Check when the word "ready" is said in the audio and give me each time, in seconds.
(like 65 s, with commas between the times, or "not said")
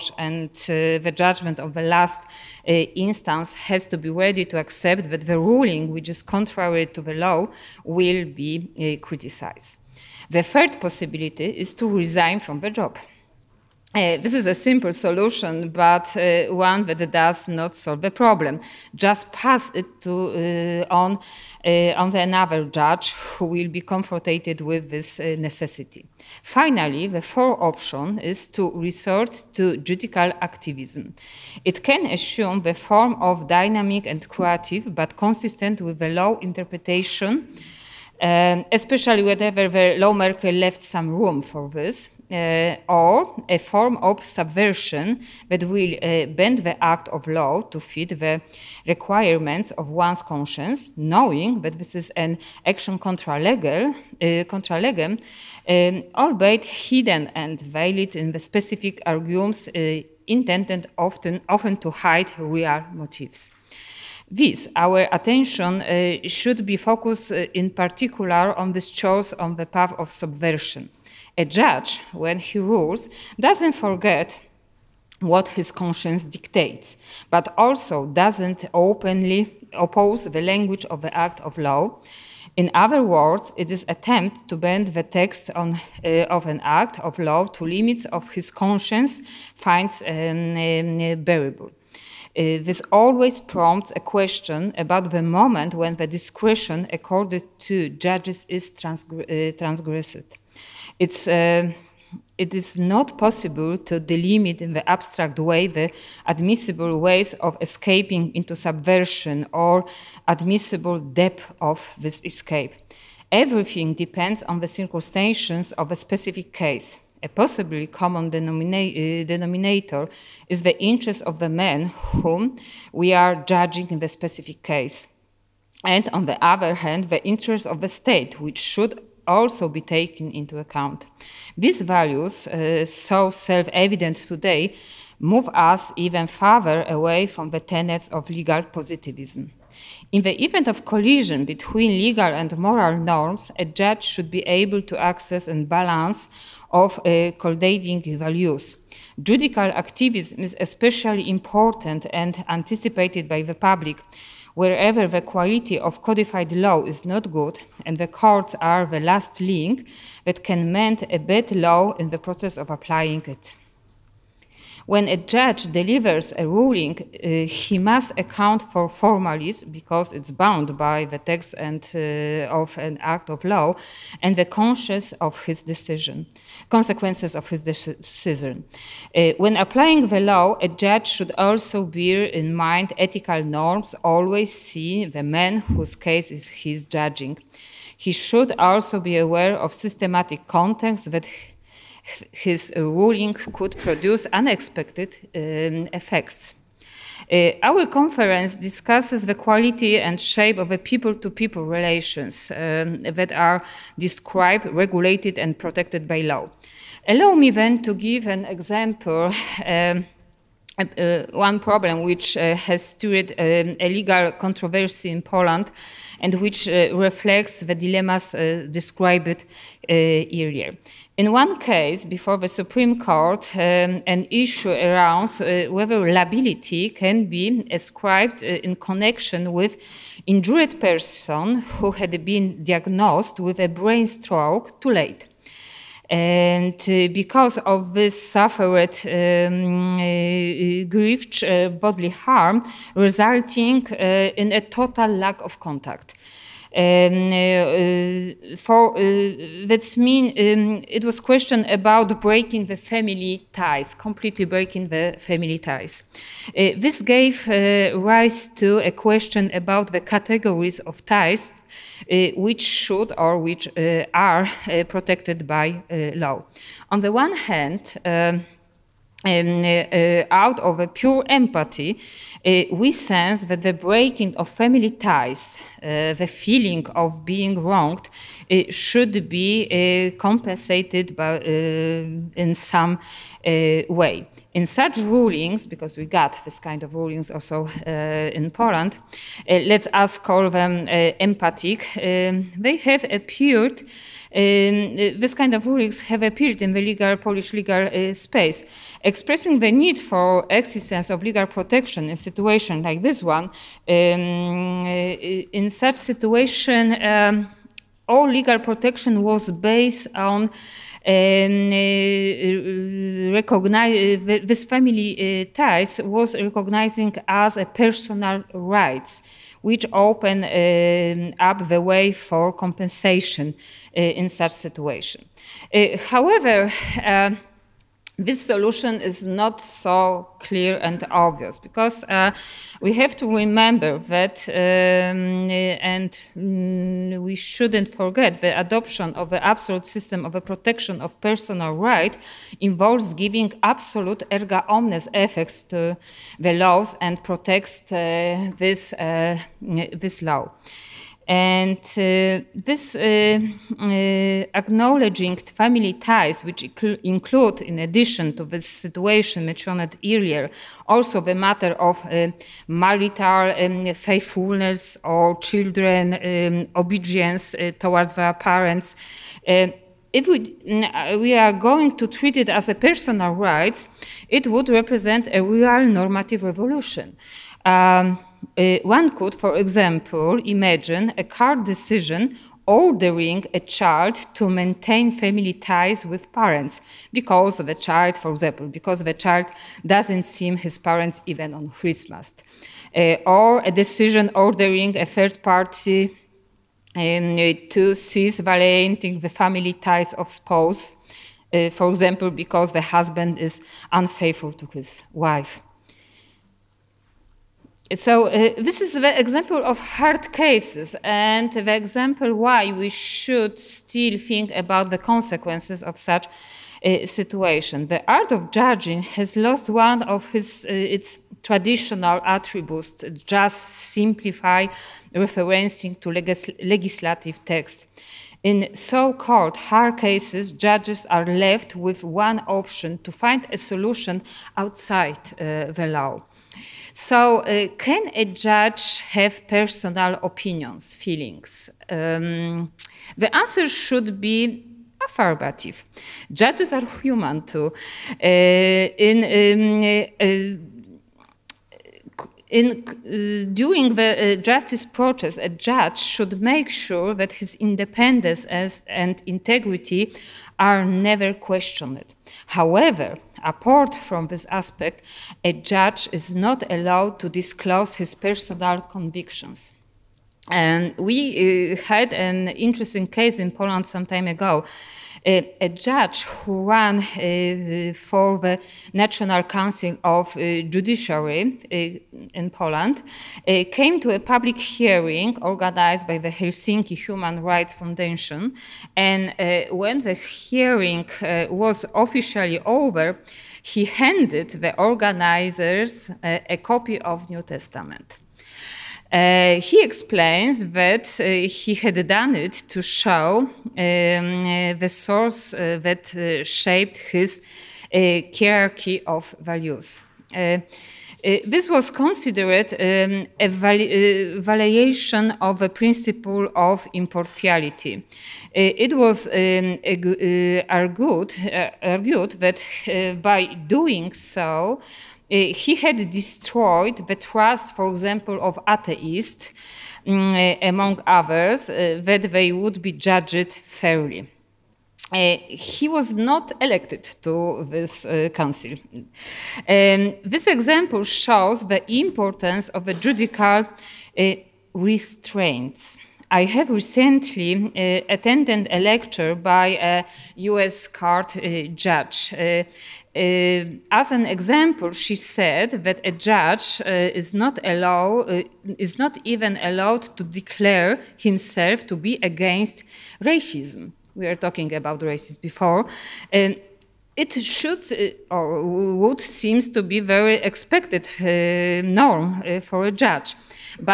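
4 s.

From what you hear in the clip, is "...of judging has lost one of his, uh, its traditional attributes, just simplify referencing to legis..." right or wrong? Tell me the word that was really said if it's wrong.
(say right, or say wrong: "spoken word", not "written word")
right.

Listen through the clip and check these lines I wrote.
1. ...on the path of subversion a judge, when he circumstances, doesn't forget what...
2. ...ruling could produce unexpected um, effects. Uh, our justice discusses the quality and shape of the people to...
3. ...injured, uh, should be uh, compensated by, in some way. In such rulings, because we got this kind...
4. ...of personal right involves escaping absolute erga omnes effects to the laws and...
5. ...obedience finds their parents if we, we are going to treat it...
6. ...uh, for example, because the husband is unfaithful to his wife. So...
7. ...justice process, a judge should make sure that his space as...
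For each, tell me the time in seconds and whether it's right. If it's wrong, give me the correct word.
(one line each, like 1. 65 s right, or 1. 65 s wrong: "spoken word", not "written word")
1. 69 s wrong: "rules", not "circumstances"
2. 192 s wrong: "conference", not "justice"
3. 277 s wrong: "wronged", not "injured"
4. 340 s wrong: "giving", not "escaping"
5. 366 s wrong: "towards", not "finds"
6. 401 s right
7. 454 s wrong: "independence", not "space".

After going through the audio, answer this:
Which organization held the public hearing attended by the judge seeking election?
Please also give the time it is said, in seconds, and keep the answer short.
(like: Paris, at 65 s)
Helsinki Human Rights Foundation, at 486 s.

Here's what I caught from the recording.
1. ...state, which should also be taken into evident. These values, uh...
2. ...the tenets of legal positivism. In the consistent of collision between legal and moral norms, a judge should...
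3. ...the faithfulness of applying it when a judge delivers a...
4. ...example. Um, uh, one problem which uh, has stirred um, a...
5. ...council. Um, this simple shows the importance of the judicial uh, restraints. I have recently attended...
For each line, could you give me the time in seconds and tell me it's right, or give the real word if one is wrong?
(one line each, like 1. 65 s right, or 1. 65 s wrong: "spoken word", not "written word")
1. 127 s wrong: "account", not "evident"
2. 137 s wrong: "event", not "consistent"
3. 162 s wrong: "process", not "faithfulness"
4. 208 s right
5. 538 s wrong: "example", not "simple".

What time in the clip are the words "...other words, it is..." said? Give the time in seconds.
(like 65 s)
82 s.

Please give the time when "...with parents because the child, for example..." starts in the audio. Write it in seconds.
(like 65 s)
386 s.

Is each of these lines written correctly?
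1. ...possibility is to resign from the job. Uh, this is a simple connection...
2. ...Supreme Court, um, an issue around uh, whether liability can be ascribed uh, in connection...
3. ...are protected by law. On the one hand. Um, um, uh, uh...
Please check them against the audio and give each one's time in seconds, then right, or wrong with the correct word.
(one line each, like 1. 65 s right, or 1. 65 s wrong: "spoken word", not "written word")
1. 10 s wrong: "solution", not "connection"
2. 222 s right
3. 264 s right.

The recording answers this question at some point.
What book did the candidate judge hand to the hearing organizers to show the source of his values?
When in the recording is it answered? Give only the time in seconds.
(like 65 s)
497 s.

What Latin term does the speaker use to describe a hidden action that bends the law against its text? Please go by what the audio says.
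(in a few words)
contra legem.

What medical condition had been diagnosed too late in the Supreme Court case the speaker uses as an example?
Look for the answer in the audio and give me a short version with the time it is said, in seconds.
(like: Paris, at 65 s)
Brain stroke, at 233 s.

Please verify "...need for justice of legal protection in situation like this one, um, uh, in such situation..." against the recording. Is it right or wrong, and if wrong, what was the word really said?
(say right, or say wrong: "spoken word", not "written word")
wrong: "existence", not "justice".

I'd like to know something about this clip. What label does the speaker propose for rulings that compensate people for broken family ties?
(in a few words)
Empathic.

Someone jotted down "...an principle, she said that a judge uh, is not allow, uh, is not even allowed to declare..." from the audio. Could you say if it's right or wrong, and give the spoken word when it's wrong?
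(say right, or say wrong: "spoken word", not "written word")
wrong: "example", not "principle".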